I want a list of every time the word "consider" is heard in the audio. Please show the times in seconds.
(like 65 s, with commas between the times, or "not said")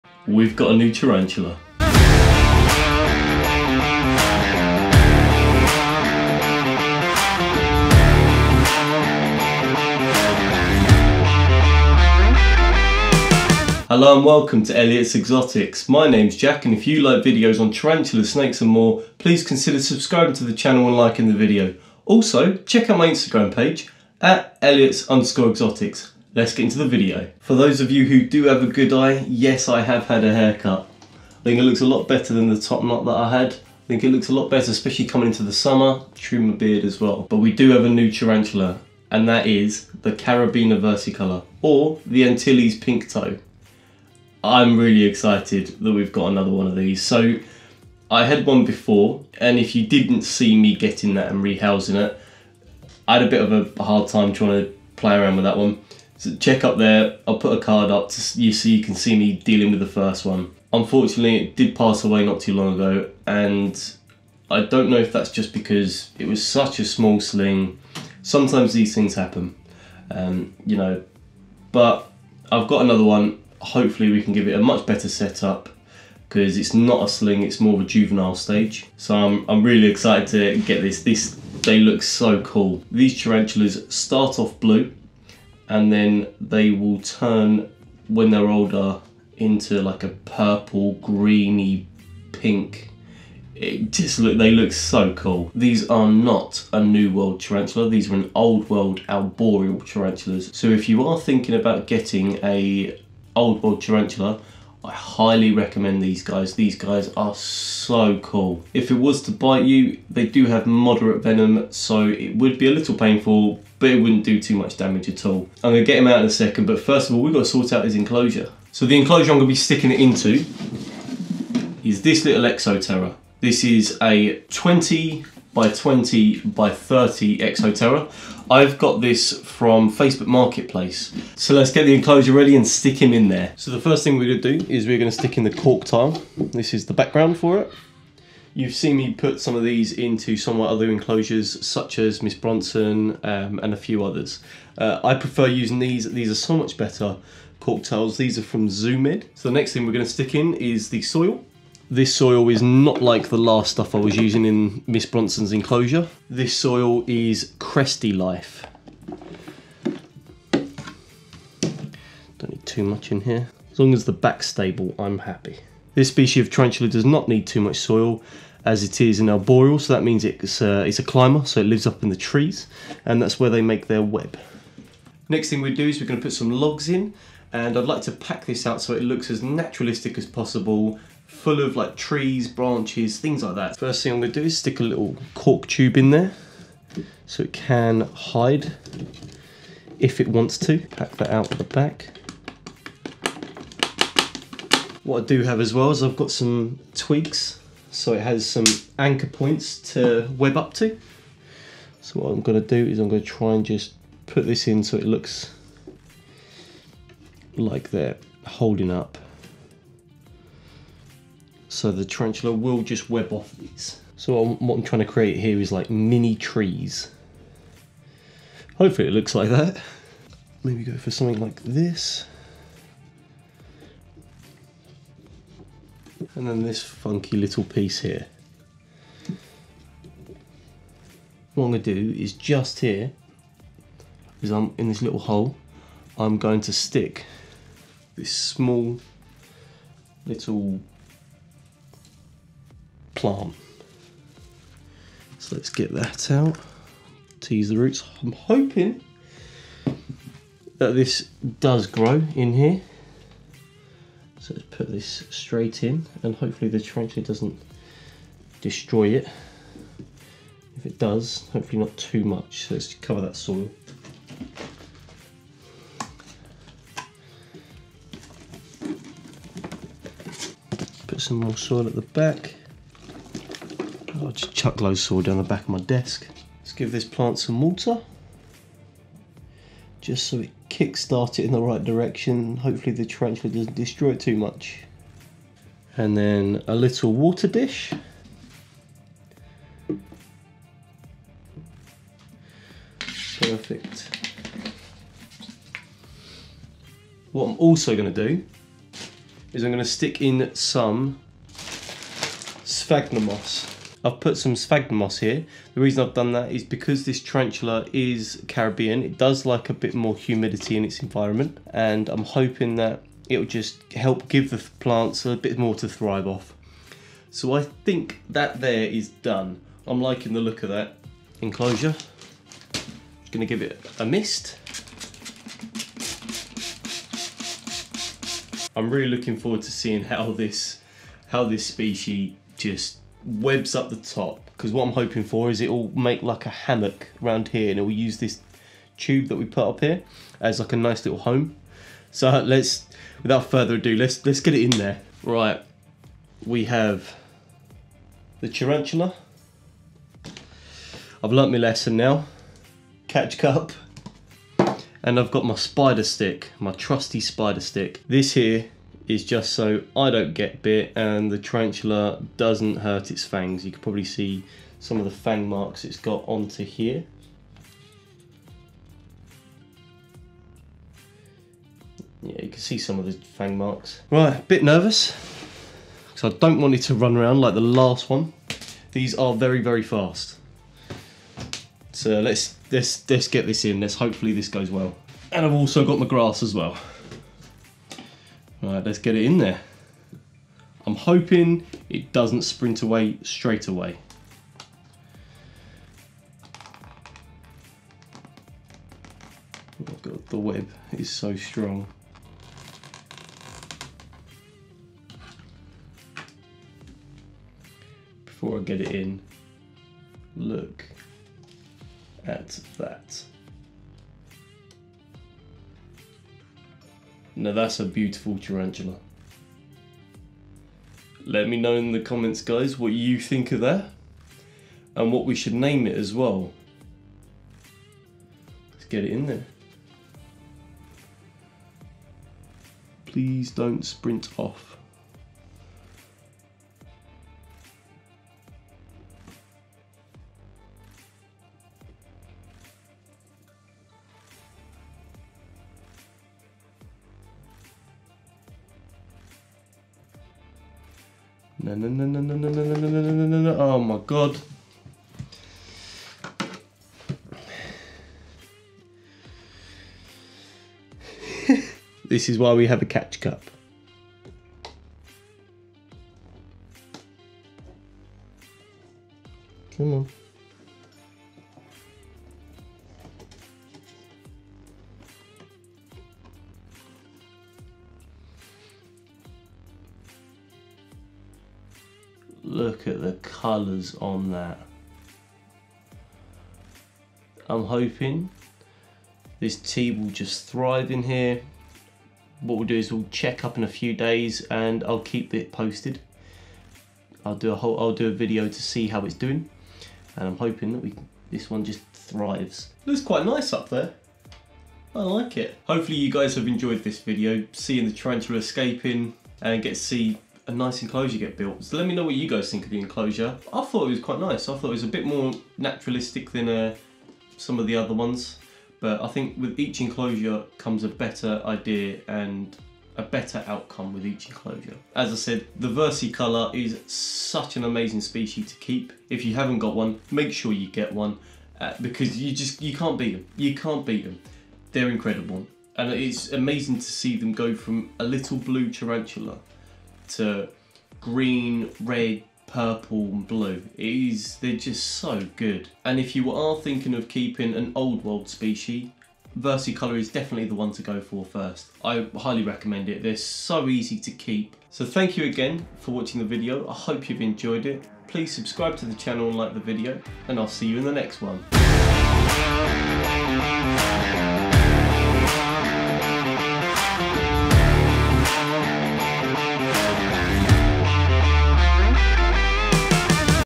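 19 s.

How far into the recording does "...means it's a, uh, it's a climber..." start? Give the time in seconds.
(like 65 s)
170 s.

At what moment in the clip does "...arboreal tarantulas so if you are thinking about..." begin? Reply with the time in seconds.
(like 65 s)
99 s.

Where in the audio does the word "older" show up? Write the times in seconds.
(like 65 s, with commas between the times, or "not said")
88 s.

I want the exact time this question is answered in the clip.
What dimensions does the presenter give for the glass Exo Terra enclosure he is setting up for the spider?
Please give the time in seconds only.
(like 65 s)
124 s.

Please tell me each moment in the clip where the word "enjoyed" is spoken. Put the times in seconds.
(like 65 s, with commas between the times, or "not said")
506 s, 557 s.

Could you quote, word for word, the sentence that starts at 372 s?
Yeah, you can see some of the fang marks.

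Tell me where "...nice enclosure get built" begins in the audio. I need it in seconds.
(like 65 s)
510 s.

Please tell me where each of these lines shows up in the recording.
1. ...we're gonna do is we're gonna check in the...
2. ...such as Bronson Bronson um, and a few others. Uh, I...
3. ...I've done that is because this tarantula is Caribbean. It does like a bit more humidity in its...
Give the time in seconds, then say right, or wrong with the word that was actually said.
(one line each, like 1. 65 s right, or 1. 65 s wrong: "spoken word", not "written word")
1. 134 s wrong: "stick", not "check"
2. 141 s wrong: "Miss", not "Bronson"
3. 306 s right.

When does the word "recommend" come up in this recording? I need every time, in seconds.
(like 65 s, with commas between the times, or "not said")
105 s, 552 s.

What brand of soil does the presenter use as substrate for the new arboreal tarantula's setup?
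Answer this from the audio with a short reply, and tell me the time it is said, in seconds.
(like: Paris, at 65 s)
Cresty Life, at 157 s.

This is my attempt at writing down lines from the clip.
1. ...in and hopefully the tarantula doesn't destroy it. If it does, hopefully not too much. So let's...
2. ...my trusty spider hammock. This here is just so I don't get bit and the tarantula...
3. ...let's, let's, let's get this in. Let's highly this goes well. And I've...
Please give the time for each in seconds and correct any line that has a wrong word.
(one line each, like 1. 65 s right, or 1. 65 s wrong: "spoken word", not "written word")
1. 255 s right
2. 356 s wrong: "stick", not "hammock"
3. 382 s wrong: "hopefully", not "highly".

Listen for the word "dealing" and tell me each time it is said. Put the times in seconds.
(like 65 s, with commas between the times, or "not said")
59 s.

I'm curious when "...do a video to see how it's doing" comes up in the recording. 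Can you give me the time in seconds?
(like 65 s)
497 s.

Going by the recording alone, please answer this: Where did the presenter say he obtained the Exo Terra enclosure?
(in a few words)
Facebook Marketplace.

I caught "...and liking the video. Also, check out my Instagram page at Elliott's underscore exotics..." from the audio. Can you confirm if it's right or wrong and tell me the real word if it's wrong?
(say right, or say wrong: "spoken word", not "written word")
right.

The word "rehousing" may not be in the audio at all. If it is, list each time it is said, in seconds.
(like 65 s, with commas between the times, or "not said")
51 s.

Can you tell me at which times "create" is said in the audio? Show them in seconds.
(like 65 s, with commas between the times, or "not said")
215 s.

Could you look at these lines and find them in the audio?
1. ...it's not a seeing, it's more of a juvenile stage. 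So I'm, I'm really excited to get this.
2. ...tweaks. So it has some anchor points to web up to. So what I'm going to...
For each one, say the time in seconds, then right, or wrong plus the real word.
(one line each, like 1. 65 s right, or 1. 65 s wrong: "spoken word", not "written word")
1. 76 s wrong: "sling", not "seeing"
2. 196 s right.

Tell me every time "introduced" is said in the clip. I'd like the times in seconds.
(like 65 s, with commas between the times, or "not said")
not said.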